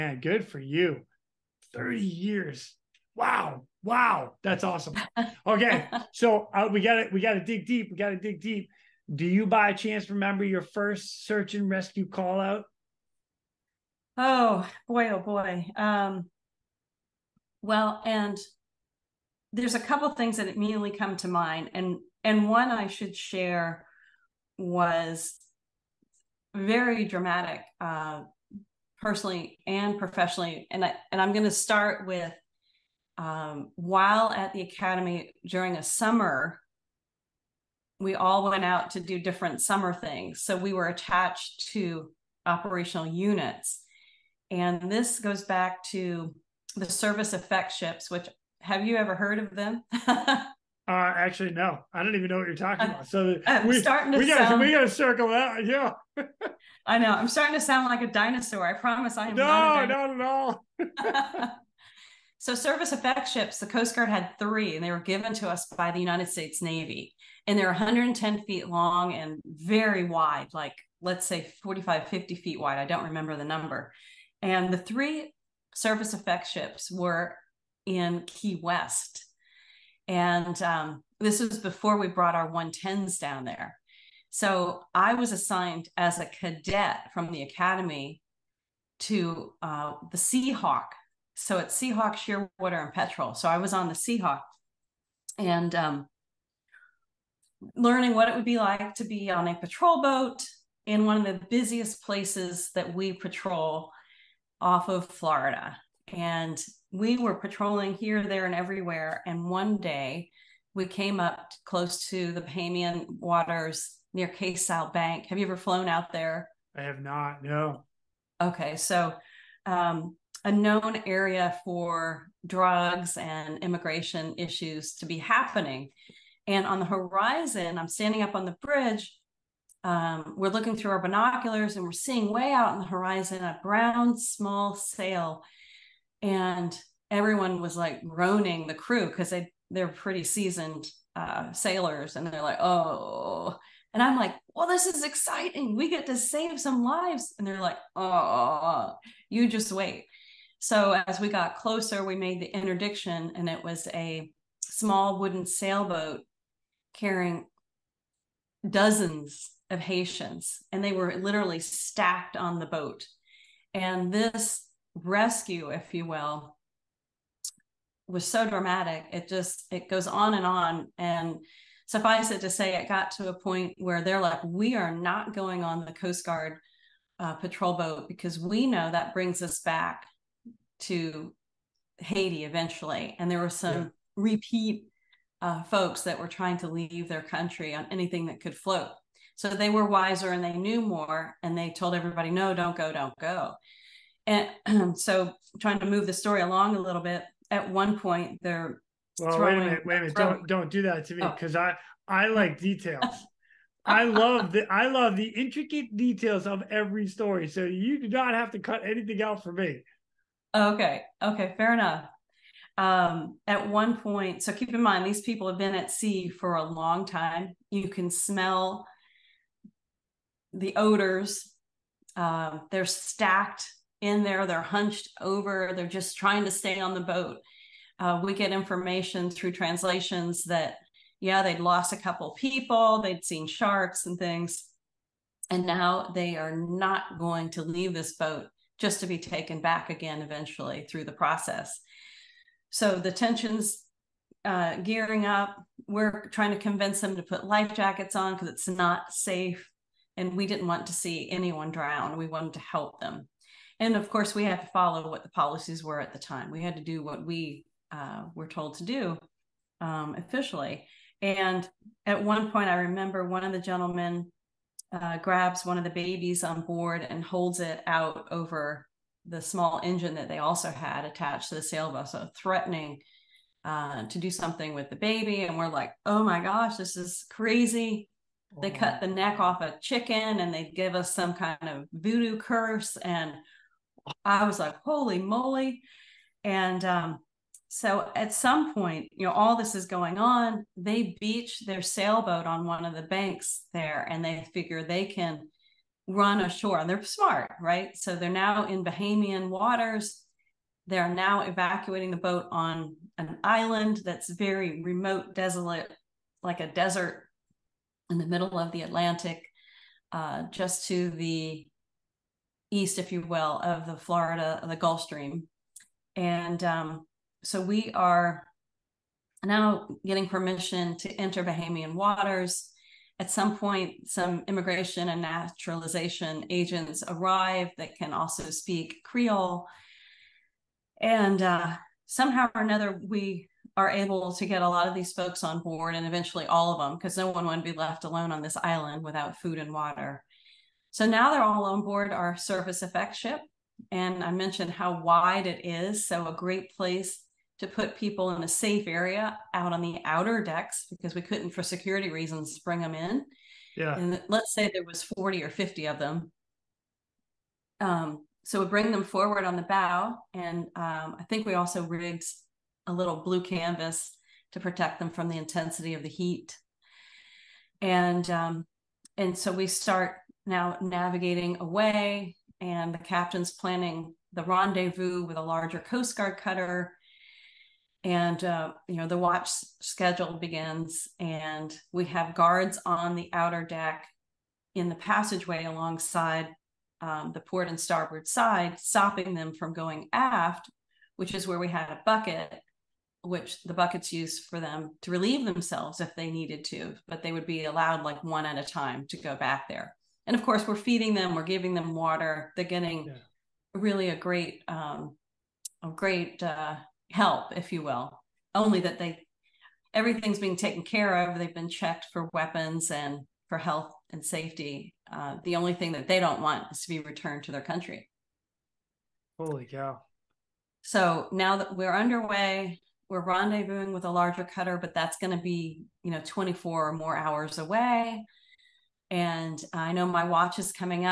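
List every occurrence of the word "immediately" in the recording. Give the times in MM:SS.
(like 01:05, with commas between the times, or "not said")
00:20.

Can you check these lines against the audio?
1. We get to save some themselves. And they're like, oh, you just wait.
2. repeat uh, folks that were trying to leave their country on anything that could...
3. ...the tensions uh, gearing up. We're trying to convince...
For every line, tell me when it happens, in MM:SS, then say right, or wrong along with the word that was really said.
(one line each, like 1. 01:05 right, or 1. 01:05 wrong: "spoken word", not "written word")
1. 02:25 wrong: "lives", not "themselves"
2. 03:04 right
3. 04:02 right.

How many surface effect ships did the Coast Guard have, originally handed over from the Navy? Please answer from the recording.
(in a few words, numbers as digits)
3.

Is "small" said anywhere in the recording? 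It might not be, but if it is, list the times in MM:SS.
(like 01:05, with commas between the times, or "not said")
02:14, 02:34, 04:29.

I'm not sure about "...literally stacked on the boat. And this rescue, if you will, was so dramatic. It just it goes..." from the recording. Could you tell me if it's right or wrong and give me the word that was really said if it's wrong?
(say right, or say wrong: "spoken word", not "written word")
right.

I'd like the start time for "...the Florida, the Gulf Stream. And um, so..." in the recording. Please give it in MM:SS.
05:13.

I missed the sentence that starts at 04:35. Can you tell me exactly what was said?
And we're like, oh my gosh, this is crazy.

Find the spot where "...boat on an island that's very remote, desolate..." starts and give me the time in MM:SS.
05:02.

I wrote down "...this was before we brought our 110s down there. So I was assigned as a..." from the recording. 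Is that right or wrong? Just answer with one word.
right.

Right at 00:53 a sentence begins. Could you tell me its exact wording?
So I'm uh, we, starting to we gotta, we gotta circle that.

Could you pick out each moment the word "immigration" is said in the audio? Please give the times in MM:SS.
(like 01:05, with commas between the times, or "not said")
02:03, 05:24.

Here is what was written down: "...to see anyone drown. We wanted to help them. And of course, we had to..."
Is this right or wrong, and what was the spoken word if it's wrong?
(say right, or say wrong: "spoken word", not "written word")
right.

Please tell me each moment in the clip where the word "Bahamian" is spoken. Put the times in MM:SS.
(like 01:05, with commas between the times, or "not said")
01:52, 04:58, 05:21.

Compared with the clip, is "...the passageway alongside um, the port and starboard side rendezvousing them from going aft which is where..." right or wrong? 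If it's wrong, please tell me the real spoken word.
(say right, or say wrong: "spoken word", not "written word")
wrong: "stopping", not "rendezvousing".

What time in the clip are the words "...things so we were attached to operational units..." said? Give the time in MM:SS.
00:39.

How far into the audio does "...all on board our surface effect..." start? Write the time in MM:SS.
05:41.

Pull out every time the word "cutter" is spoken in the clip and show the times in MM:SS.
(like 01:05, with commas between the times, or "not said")
06:16, 07:04.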